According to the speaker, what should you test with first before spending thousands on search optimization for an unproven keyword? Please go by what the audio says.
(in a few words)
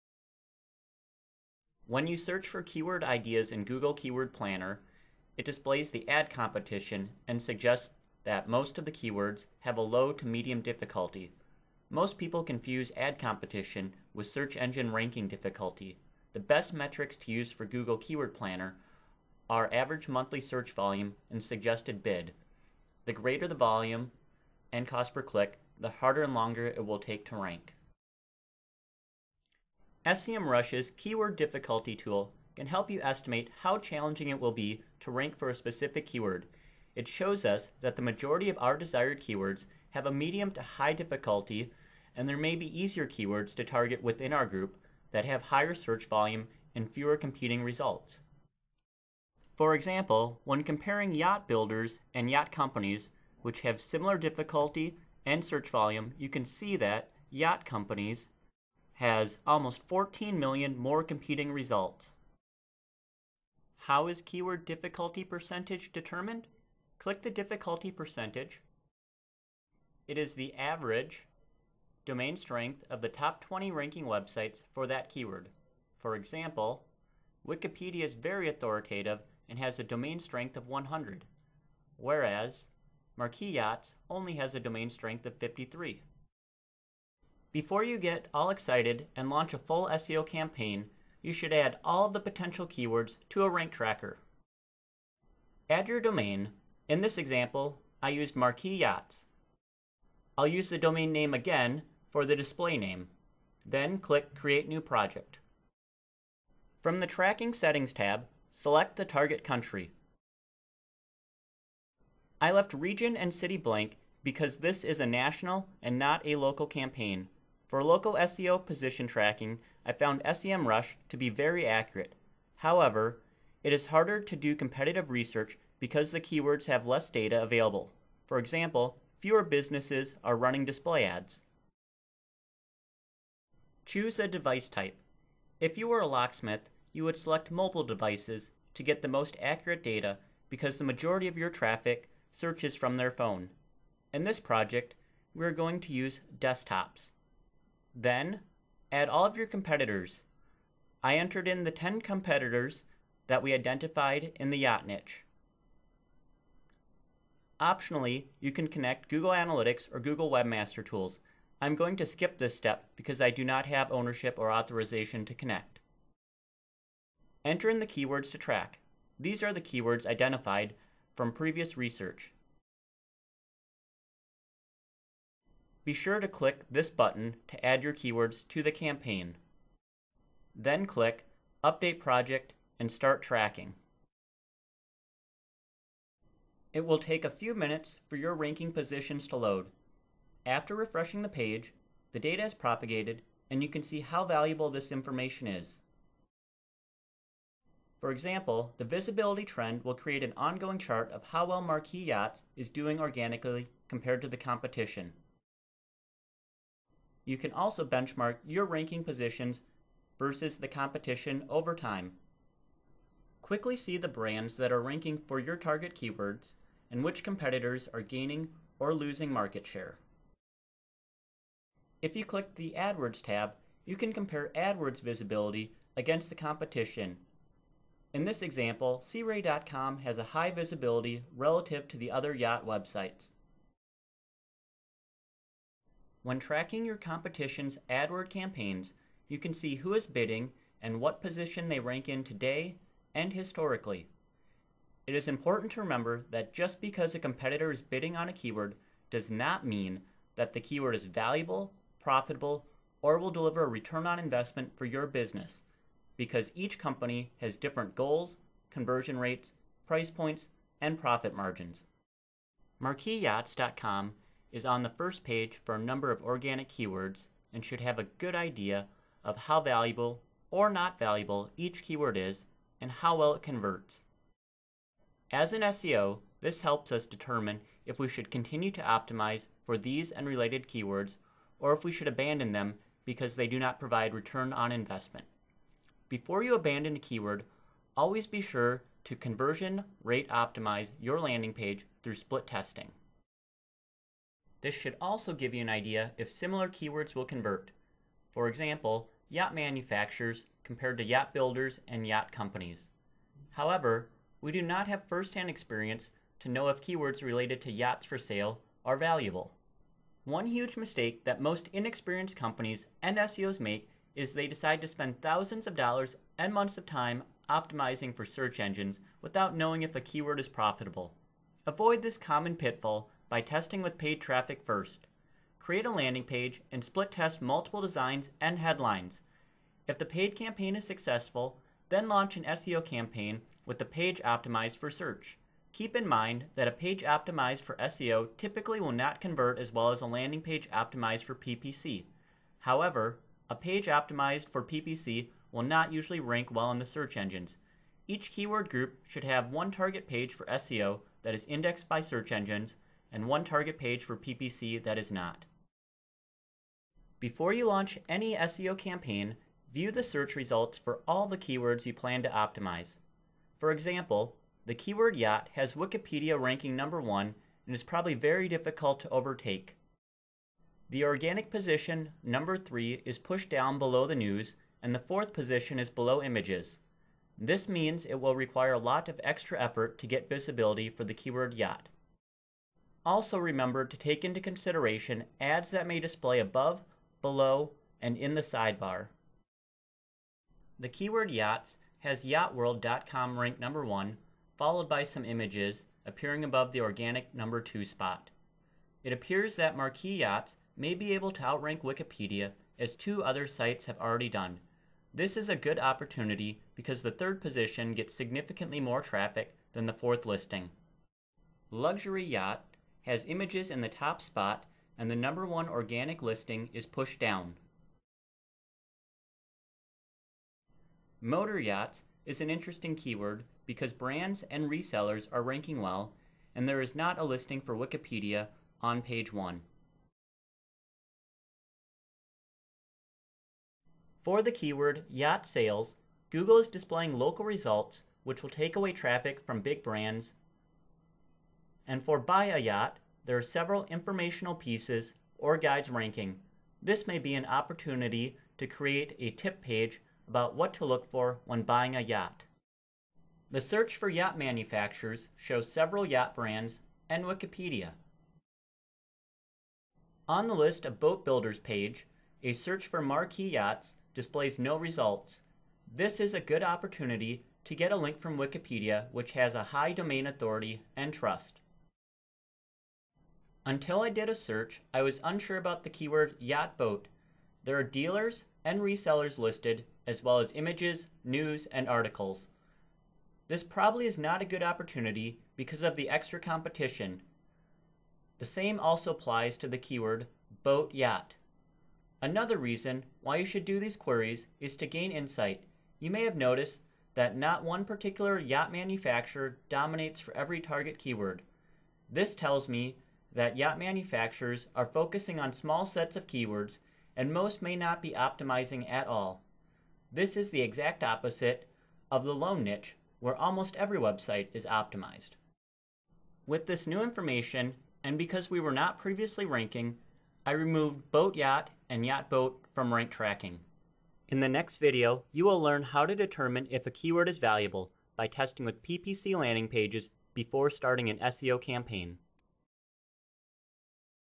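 paid traffic.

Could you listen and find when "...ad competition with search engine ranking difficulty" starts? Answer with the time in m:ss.
0:12.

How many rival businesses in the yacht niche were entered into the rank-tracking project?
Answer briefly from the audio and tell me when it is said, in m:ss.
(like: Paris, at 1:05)
10, at 2:31.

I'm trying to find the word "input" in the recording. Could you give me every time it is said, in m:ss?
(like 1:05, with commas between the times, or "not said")
not said.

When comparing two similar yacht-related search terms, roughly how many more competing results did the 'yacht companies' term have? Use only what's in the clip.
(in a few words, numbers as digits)
14 million.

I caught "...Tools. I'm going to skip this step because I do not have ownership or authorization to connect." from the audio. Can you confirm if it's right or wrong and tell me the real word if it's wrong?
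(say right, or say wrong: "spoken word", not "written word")
right.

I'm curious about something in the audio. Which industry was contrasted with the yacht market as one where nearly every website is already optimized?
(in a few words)
loan niche.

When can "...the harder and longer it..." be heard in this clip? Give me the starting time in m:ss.
0:25.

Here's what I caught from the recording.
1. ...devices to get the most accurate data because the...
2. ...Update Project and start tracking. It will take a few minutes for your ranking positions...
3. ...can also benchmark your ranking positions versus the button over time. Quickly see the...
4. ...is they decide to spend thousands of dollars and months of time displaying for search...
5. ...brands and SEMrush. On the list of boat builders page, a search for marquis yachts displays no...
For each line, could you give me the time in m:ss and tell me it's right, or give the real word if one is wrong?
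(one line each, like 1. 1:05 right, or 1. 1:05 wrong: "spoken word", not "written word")
1. 2:17 right
2. 3:01 right
3. 3:27 wrong: "competition", not "button"
4. 5:14 wrong: "optimizing", not "displaying"
5. 7:36 wrong: "Wikipedia", not "SEMrush".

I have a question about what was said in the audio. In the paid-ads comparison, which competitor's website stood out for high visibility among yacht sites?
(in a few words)
SeaRay.com.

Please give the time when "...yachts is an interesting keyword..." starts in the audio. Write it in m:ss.
7:01.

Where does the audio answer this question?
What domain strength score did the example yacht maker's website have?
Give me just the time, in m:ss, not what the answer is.
1:25.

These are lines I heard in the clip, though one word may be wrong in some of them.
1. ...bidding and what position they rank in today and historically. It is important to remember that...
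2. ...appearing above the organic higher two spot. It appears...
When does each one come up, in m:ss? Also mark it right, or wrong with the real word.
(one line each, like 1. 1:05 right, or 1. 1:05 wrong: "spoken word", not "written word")
1. 4:00 right
2. 6:36 wrong: "number", not "higher".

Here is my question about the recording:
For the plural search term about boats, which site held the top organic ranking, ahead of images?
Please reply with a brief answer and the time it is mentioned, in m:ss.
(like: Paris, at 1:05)
yachtworld.com, at 6:32.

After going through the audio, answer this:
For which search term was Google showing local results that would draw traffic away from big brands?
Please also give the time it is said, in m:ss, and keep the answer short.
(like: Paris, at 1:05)
yacht sales, at 7:15.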